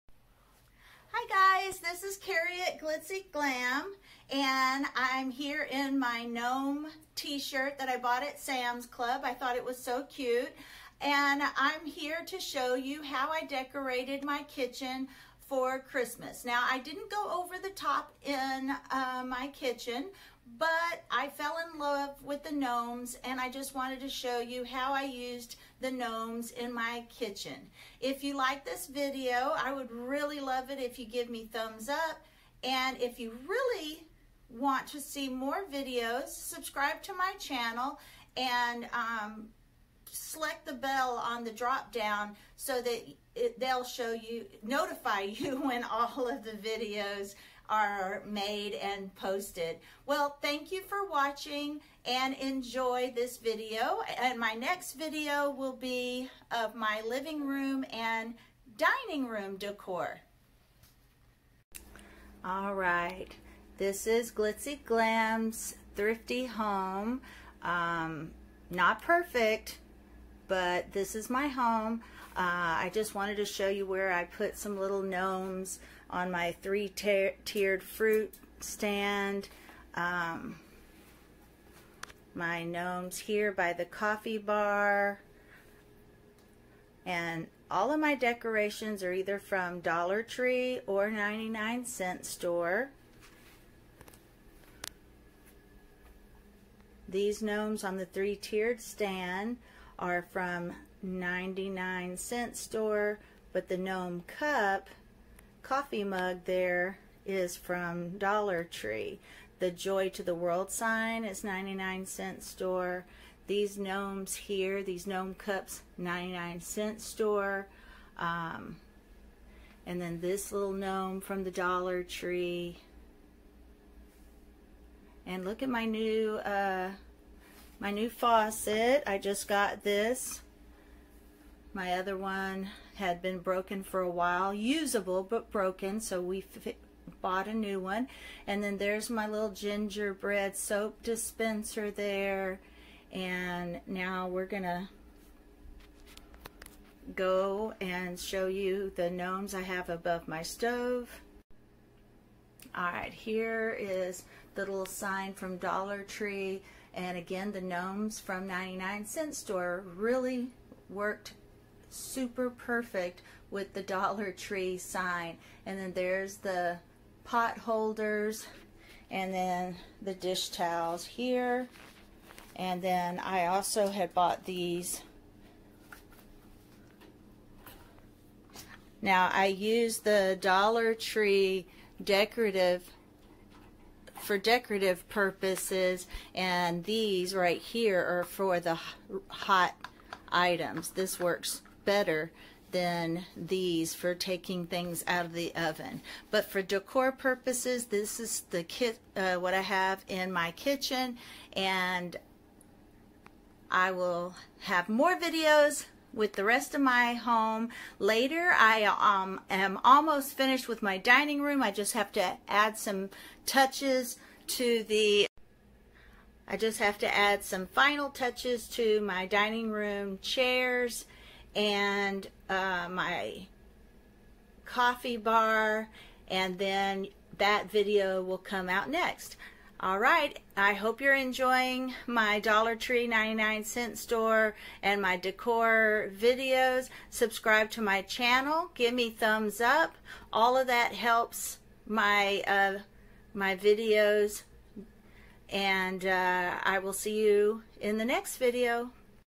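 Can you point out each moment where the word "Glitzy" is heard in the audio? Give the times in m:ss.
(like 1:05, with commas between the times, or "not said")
0:02, 1:04.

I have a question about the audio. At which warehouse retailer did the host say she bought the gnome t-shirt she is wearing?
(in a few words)
Sam's Club.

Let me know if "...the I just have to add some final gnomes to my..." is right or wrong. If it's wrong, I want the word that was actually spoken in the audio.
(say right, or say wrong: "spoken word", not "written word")
wrong: "touches", not "gnomes".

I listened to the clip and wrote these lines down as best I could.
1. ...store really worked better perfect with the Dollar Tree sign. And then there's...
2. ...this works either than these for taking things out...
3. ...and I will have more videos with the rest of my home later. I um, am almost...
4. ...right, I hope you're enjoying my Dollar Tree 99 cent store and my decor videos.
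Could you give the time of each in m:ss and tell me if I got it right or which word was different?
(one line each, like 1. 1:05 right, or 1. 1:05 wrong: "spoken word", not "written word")
1. 2:39 wrong: "super", not "better"
2. 3:10 wrong: "better", not "either"
3. 3:21 right
4. 3:49 right.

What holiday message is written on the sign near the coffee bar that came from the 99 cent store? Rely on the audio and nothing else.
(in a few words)
Joy to the World.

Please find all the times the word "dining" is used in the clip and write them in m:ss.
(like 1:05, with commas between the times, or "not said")
0:58, 3:30, 3:39.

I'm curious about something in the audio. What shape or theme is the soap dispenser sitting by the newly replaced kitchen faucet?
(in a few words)
Gingerbread.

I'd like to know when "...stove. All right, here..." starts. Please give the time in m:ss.
2:30.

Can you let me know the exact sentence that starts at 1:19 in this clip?
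Um, my gnomes here by the coffee bar.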